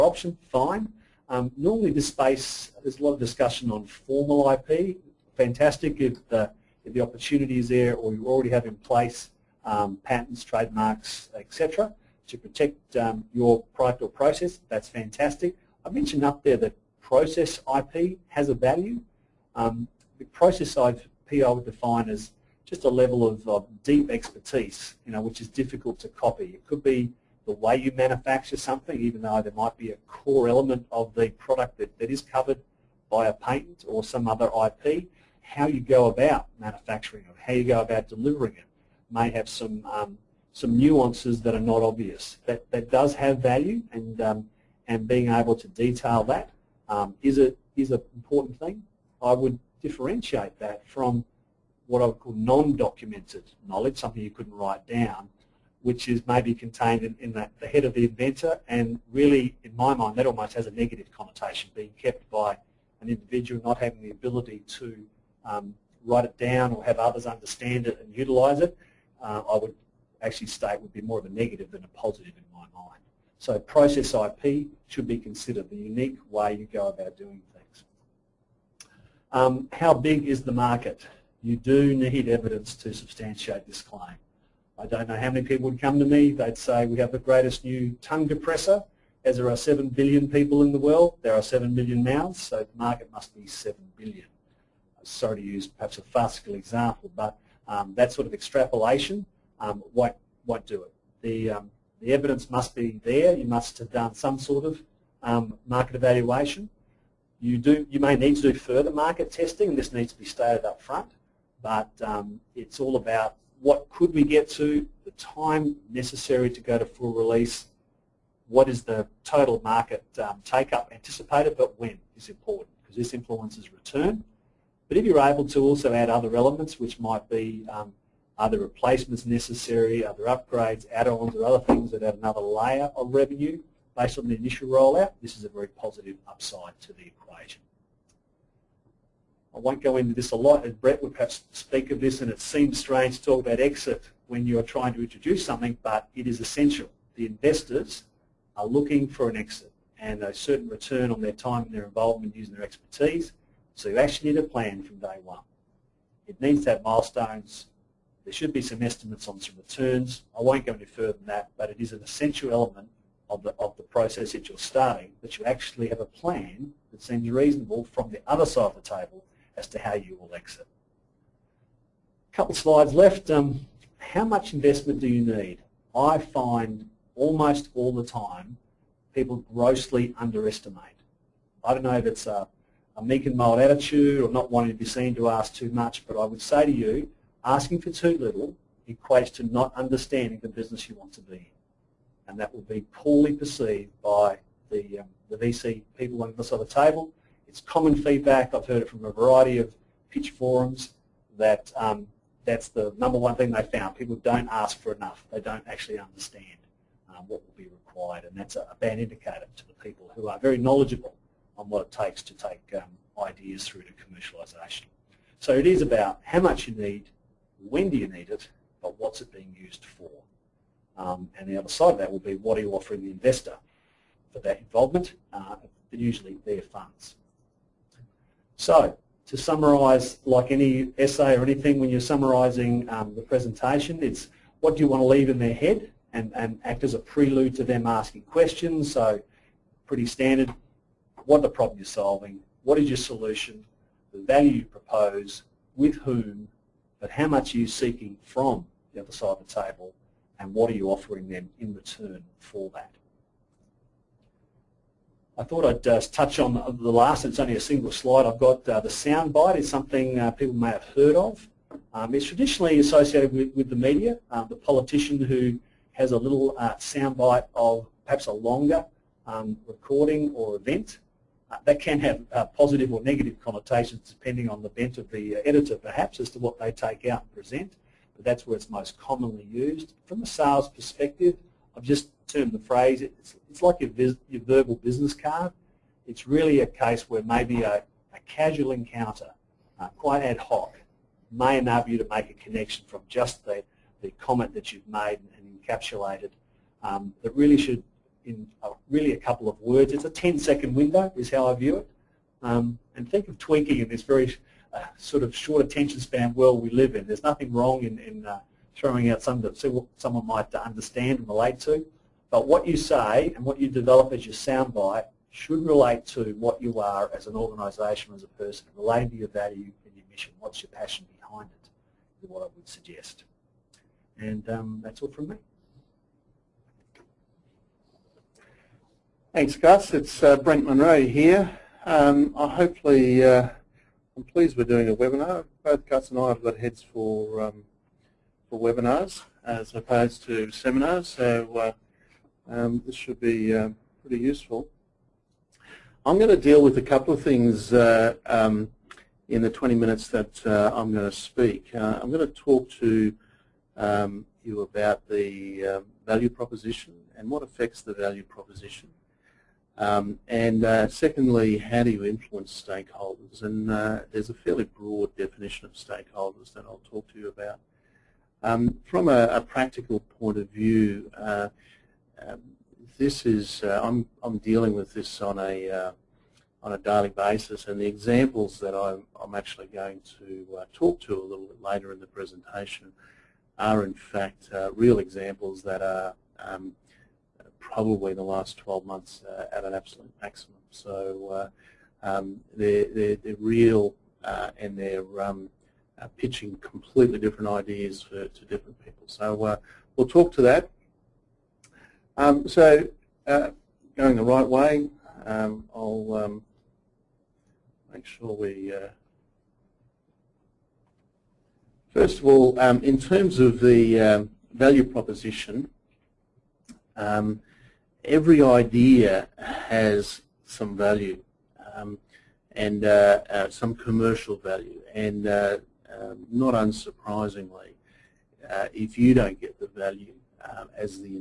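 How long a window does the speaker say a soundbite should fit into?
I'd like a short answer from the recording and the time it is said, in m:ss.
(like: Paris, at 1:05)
10 seconds, at 5:00.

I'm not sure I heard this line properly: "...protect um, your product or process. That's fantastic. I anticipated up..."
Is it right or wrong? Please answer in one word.
wrong.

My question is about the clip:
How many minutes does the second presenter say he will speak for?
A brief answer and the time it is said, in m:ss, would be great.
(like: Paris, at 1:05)
20, at 5:49.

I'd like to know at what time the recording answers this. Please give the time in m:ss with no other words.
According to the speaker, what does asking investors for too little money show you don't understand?
3:10.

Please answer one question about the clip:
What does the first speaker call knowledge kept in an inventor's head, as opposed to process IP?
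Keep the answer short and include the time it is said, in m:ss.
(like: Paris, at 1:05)
non-documented knowledge, at 0:52.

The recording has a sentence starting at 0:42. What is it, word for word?
That that does have value, and um, and being able to detail that um, is a is an important thing.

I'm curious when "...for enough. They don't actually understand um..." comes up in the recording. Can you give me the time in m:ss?
3:24.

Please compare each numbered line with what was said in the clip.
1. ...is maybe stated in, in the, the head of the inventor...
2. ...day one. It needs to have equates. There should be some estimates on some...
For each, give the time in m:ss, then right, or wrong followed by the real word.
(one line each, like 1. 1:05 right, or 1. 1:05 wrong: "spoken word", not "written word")
1. 0:56 wrong: "contained", not "stated"
2. 2:34 wrong: "milestones", not "equates".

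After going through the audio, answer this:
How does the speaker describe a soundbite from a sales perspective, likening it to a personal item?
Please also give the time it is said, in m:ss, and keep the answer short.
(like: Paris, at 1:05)
verbal business card, at 4:44.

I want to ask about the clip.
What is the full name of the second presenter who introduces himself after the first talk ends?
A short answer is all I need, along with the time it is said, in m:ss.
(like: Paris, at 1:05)
Brendt Munro, at 5:30.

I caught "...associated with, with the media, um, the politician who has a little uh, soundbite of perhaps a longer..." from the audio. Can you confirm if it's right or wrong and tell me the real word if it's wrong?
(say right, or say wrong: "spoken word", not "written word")
right.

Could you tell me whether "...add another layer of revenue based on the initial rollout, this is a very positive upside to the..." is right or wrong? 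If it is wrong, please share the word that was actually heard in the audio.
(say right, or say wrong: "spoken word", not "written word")
right.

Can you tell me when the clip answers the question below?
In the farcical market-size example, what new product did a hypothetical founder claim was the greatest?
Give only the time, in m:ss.
1:28.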